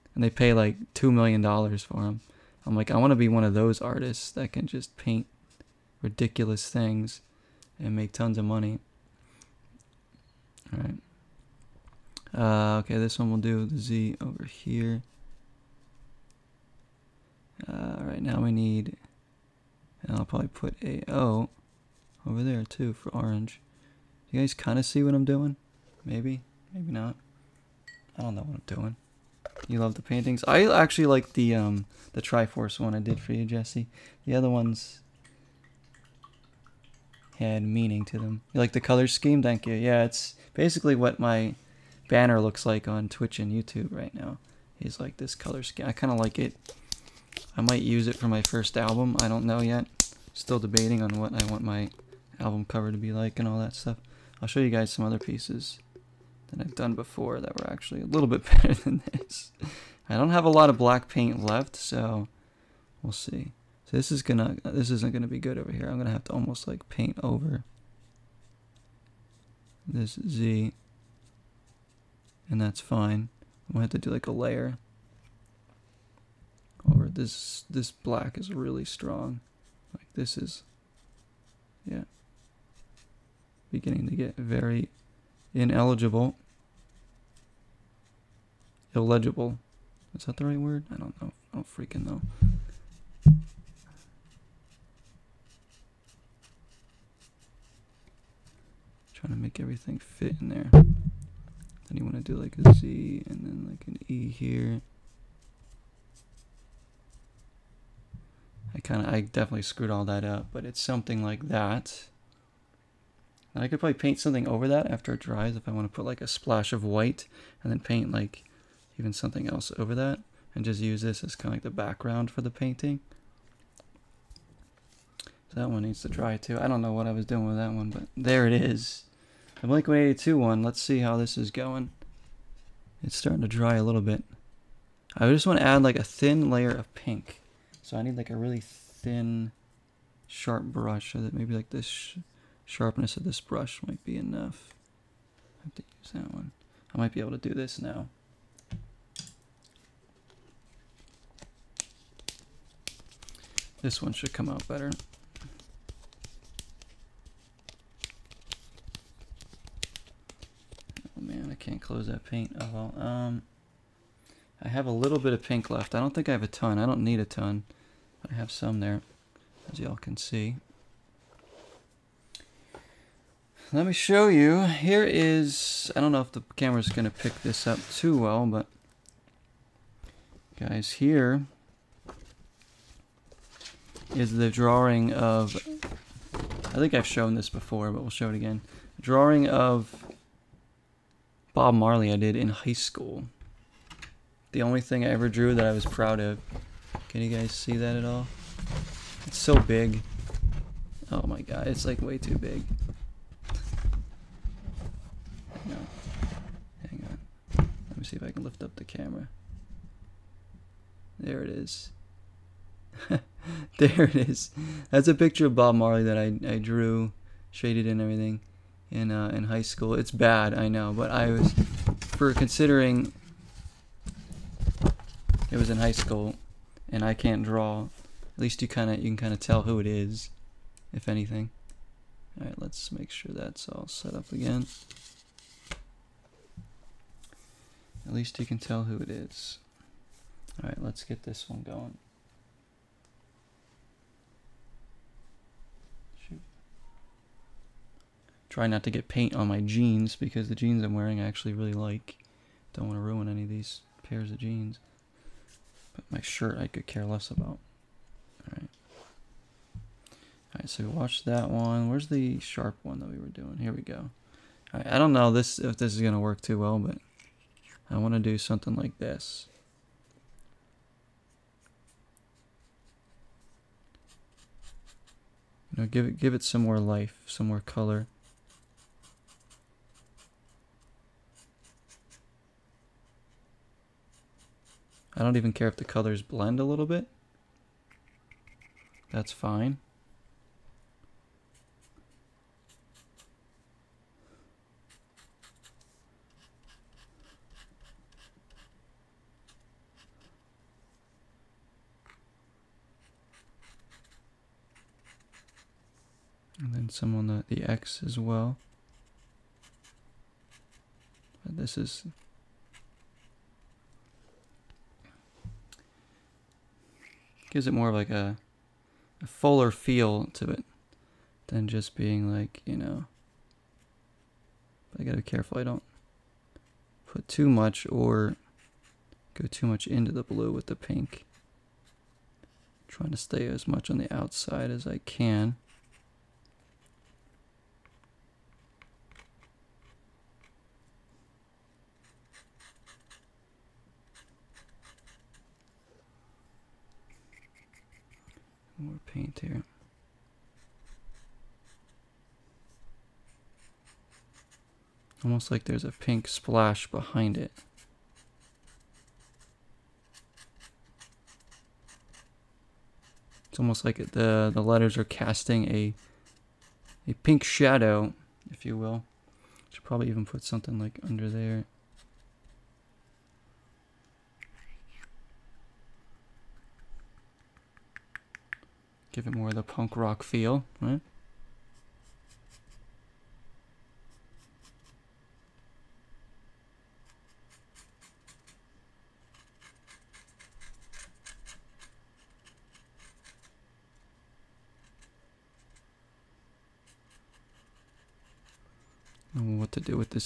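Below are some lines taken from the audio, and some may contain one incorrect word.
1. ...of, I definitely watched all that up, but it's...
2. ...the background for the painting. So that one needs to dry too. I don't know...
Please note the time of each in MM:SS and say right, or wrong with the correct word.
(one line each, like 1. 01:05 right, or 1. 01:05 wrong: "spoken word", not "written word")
1. 01:49 wrong: "screwed", not "watched"
2. 02:01 right.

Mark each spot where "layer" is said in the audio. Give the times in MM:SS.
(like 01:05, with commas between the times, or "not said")
01:14, 02:16.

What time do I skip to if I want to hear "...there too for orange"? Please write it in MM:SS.
00:22.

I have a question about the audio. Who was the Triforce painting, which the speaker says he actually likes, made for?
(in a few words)
Jesse.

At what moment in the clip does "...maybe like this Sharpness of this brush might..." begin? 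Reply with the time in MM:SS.
02:21.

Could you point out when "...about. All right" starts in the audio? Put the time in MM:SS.
04:17.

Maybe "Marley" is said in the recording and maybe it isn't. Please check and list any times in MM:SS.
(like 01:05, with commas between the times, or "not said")
03:11, 03:35.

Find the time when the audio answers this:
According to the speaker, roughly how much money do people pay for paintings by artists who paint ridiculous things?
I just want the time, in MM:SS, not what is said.
00:00.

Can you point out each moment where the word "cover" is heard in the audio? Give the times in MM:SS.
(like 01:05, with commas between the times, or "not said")
00:52.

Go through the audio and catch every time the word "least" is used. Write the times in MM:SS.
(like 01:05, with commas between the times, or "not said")
03:48, 03:58.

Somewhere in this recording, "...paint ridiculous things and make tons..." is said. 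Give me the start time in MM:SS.
00:04.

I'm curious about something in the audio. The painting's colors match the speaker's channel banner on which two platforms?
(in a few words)
Twitch and YouTube.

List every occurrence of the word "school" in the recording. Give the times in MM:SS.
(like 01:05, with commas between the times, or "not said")
03:12, 03:39, 03:45.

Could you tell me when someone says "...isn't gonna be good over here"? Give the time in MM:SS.
01:04.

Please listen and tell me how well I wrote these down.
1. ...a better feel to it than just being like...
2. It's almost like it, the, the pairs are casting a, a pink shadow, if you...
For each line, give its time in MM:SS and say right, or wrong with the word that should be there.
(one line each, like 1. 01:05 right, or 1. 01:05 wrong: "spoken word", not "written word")
1. 05:19 wrong: "fuller", not "better"
2. 06:03 wrong: "letters", not "pairs".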